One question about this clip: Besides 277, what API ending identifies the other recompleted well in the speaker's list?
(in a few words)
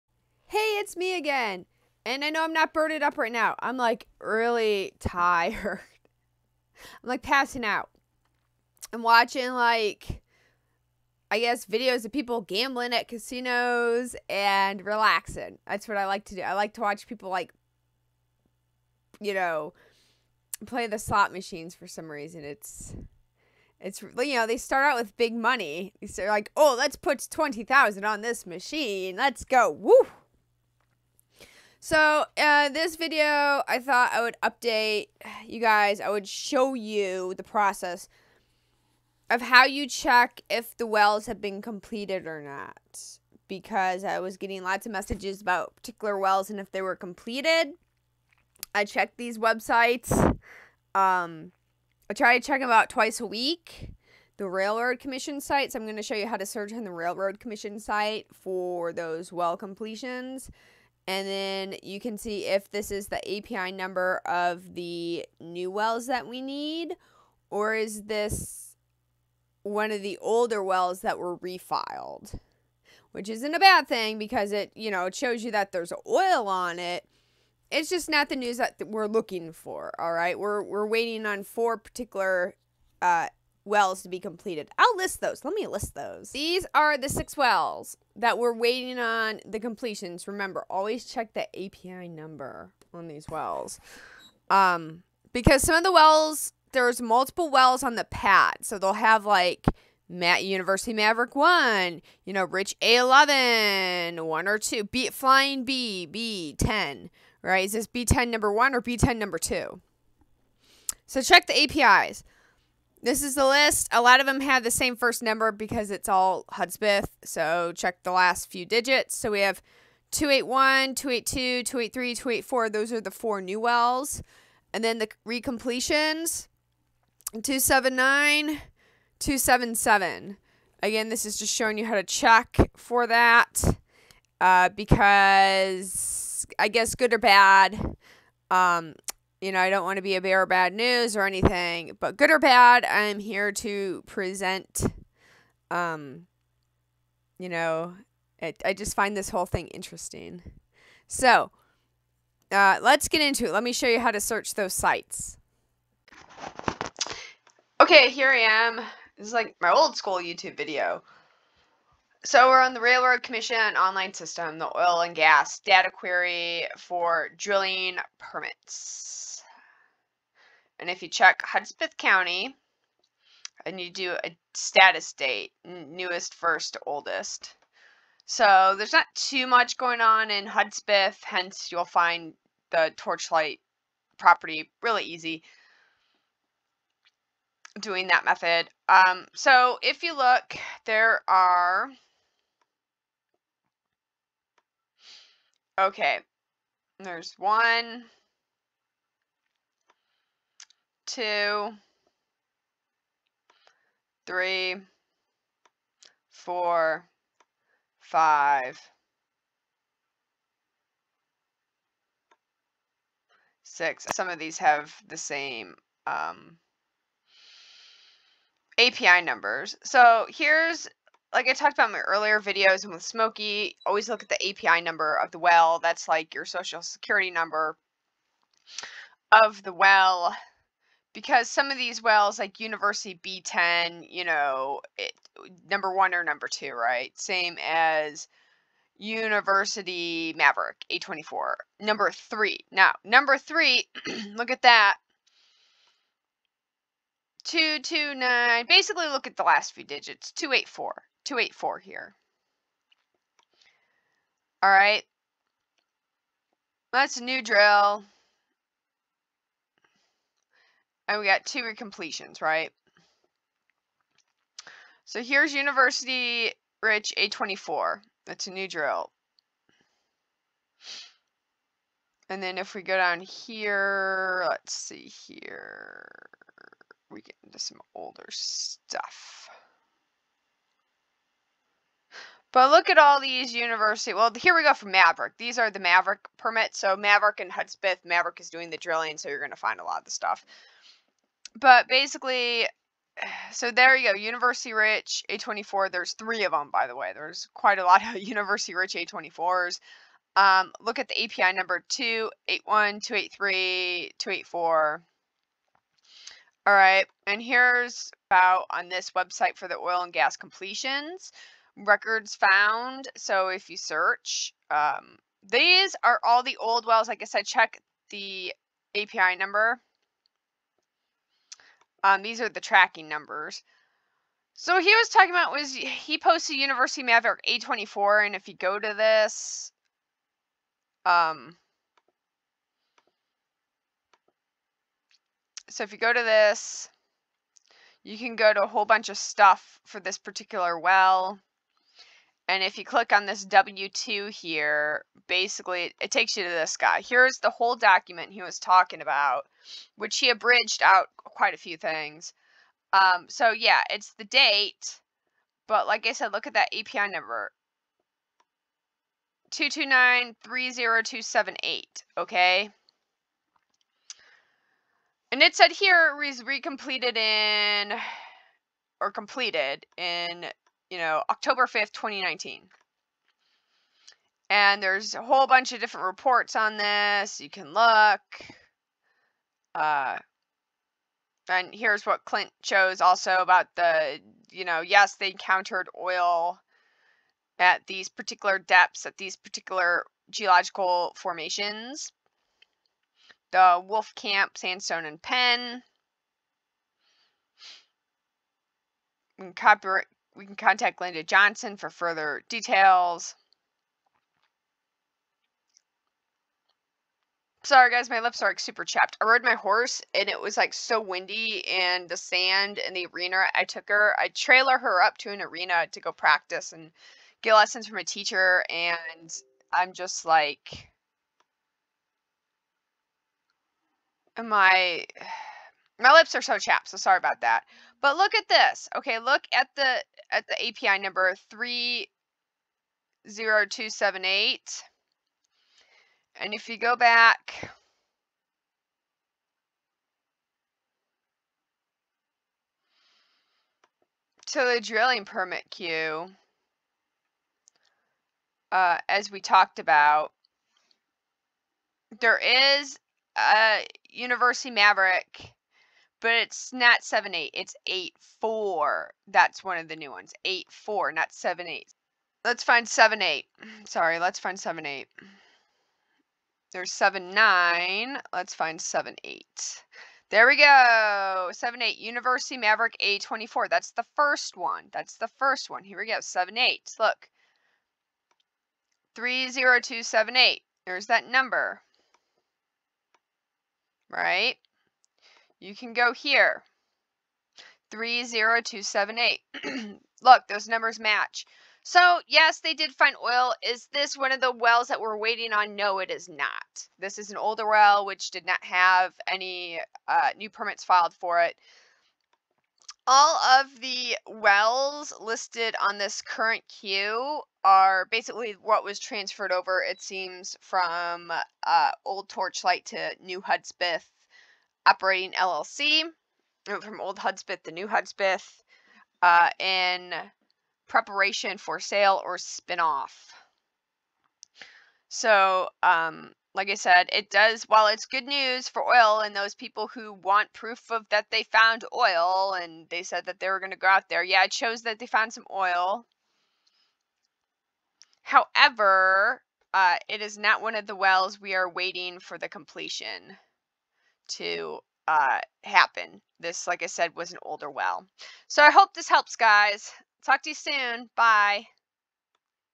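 279.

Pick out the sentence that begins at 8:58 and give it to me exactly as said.
However, uh, it is not one of the wells we are waiting for the completion to uh, happen.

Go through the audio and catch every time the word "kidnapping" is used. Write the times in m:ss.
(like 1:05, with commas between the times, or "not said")
not said.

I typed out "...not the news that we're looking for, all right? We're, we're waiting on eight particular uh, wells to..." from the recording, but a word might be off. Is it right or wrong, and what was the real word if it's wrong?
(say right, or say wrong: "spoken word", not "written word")
wrong: "four", not "eight".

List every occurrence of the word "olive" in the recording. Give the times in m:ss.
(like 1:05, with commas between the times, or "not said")
not said.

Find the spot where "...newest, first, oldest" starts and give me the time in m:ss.
2:55.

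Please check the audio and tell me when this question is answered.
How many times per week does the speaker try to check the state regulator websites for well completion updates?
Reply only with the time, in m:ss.
0:52.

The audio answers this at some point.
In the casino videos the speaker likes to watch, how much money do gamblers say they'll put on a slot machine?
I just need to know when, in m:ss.
0:27.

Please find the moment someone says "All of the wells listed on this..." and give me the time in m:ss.
8:23.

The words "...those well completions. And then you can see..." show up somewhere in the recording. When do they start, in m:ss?
0:58.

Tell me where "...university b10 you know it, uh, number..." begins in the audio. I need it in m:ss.
3:52.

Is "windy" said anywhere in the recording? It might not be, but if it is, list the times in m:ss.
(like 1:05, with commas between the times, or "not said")
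6:51.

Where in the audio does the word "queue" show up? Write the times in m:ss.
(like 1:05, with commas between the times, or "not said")
7:25, 8:26.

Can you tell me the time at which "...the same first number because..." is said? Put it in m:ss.
1:54.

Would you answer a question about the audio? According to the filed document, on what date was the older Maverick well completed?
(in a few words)
October 5th, 2019.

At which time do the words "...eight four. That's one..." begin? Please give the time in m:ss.
7:37.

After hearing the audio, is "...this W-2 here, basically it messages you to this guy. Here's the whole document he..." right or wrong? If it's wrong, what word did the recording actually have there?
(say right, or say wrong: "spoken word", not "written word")
wrong: "takes", not "messages".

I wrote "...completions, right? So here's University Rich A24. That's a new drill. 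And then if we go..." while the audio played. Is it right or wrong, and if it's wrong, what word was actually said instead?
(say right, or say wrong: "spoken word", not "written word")
right.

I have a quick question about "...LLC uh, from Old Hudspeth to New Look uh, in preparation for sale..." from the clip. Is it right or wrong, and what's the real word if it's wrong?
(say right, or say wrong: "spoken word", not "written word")
wrong: "Hudspeth", not "Look".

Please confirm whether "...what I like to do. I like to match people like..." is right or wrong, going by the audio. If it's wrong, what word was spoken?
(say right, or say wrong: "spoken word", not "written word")
wrong: "watch", not "match".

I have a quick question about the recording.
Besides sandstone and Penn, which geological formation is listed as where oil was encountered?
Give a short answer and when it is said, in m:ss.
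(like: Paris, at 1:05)
Wolf Camp, at 6:33.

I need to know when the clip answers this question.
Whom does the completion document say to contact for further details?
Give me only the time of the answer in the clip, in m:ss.
6:41.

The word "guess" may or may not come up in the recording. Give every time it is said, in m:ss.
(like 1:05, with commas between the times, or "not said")
0:11, 2:16.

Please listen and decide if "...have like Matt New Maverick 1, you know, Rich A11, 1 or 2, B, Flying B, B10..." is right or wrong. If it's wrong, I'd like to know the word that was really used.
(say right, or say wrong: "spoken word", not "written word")
wrong: "University", not "New".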